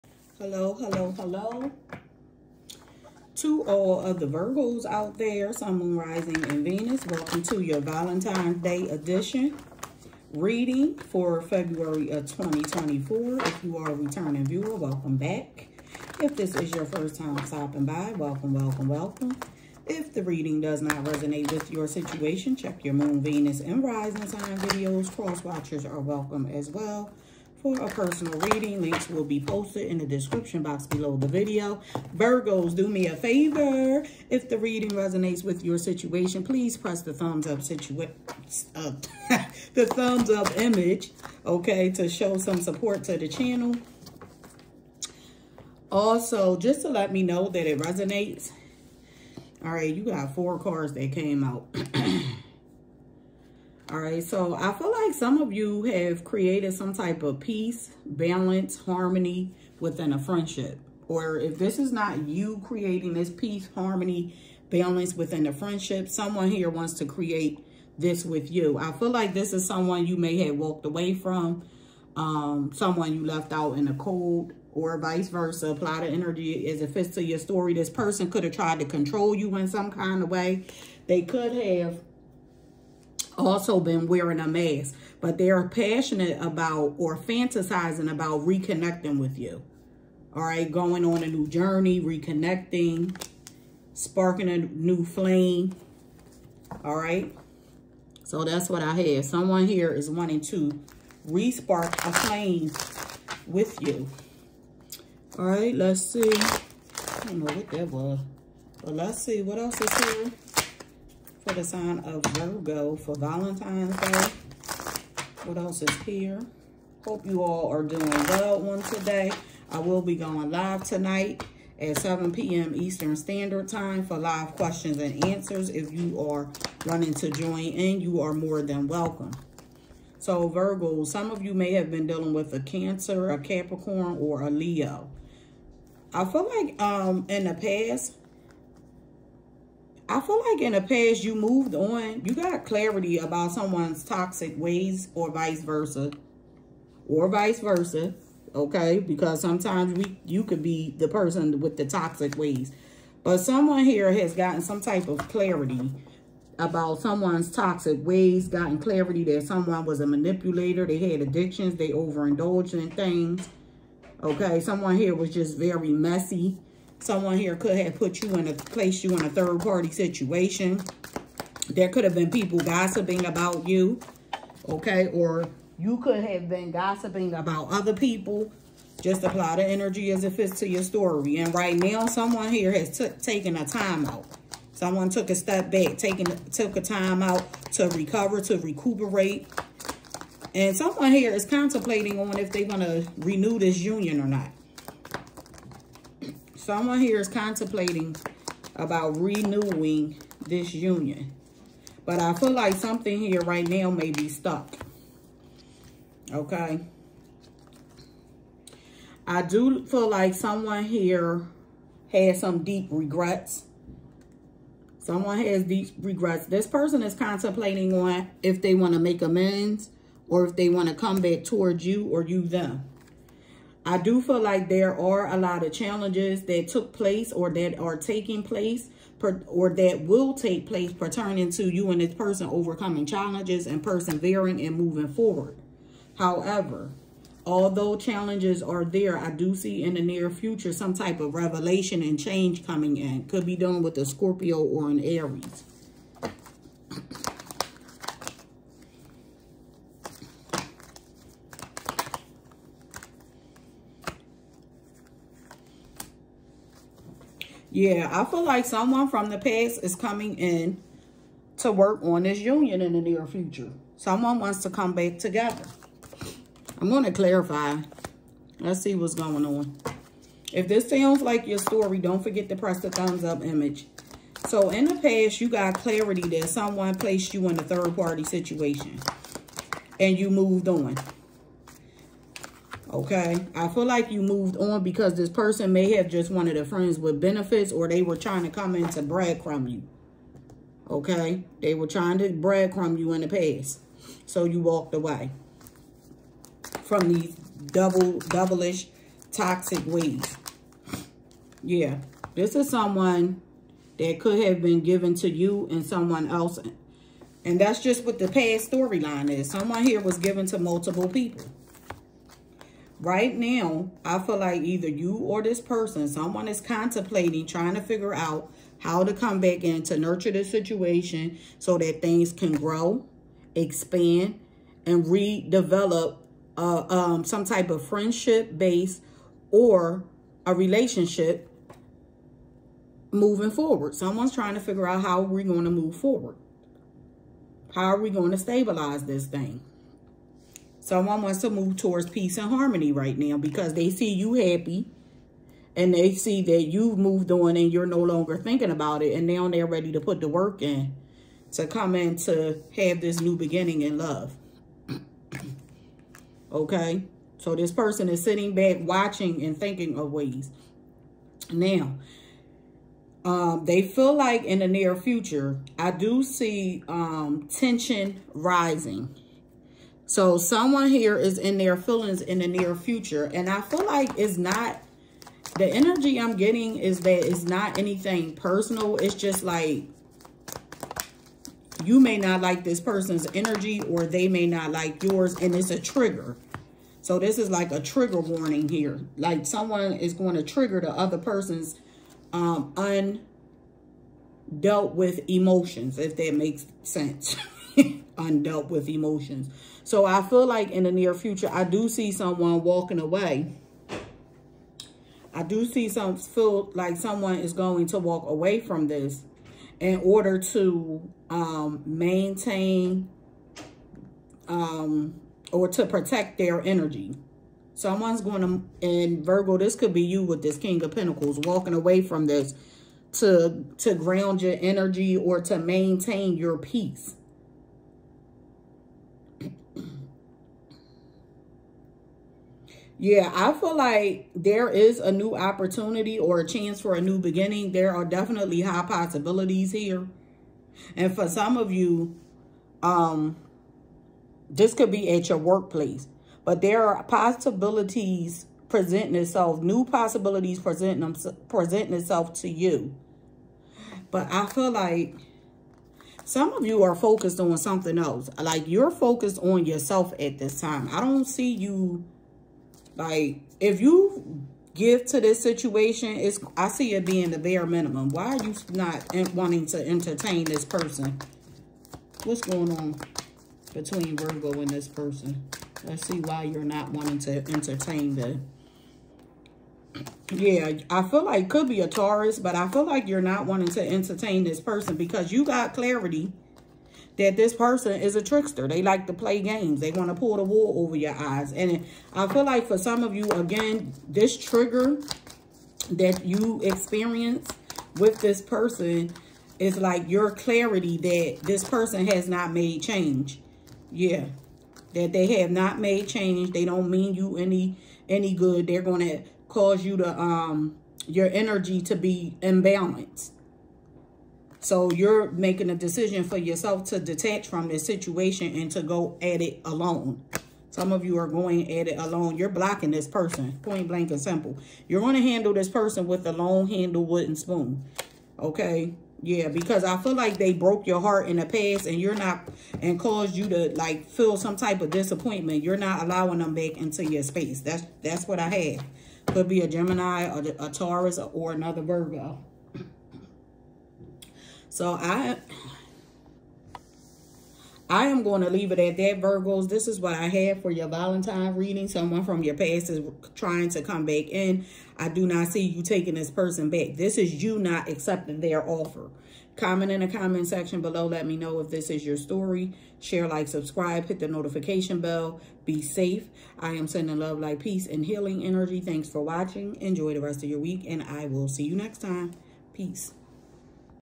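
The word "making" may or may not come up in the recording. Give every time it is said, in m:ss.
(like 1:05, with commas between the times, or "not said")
8:35.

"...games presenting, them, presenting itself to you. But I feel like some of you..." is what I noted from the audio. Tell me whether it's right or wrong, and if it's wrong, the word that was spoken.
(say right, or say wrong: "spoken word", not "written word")
wrong: "possibilities", not "games".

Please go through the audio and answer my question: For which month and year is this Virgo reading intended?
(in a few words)
February 2024.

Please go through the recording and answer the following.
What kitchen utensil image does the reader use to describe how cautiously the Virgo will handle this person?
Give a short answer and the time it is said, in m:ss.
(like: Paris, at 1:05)
long handle wooden spoon, at 8:46.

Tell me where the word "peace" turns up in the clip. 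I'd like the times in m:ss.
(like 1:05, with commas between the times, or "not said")
0:57, 1:03, 5:42, 7:06, 9:27, 9:32.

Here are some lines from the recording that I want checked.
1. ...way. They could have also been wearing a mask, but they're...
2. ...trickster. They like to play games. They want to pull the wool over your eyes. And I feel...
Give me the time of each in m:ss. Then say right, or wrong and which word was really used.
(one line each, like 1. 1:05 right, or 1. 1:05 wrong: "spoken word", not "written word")
1. 1:20 right
2. 8:08 right.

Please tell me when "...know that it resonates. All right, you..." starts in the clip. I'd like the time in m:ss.
0:47.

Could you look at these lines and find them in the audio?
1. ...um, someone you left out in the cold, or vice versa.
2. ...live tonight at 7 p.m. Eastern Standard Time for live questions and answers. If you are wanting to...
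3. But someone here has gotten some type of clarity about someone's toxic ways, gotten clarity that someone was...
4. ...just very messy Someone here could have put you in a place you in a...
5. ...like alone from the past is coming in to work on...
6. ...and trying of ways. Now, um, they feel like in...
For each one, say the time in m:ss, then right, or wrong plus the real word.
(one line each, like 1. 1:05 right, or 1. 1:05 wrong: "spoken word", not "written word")
1. 1:12 right
2. 2:00 right
3. 2:33 right
4. 2:45 right
5. 4:18 wrong: "someone", not "alone"
6. 5:59 wrong: "thinking", not "trying".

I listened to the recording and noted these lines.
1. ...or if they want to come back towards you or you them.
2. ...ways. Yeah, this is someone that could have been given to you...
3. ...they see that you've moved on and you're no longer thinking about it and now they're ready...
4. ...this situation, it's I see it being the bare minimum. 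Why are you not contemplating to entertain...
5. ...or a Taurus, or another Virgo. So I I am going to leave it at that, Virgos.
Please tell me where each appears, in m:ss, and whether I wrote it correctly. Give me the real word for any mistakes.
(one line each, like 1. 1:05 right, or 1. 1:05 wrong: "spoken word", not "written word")
1. 3:40 right
2. 4:59 right
3. 5:45 right
4. 7:45 wrong: "wanting", not "contemplating"
5. 9:00 right.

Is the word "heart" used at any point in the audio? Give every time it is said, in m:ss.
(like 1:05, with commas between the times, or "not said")
8:51.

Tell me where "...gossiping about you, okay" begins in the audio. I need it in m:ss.
2:52.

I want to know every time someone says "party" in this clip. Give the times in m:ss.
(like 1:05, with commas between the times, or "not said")
2:49, 4:37.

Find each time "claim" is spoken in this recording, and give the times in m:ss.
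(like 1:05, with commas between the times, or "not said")
not said.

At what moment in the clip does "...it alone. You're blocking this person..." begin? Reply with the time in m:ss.
8:41.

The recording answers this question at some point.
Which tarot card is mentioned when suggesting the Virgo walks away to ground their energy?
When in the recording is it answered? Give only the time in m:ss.
7:00.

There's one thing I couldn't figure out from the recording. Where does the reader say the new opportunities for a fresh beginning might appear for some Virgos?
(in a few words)
workplace.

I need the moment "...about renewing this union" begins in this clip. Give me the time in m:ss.
3:18.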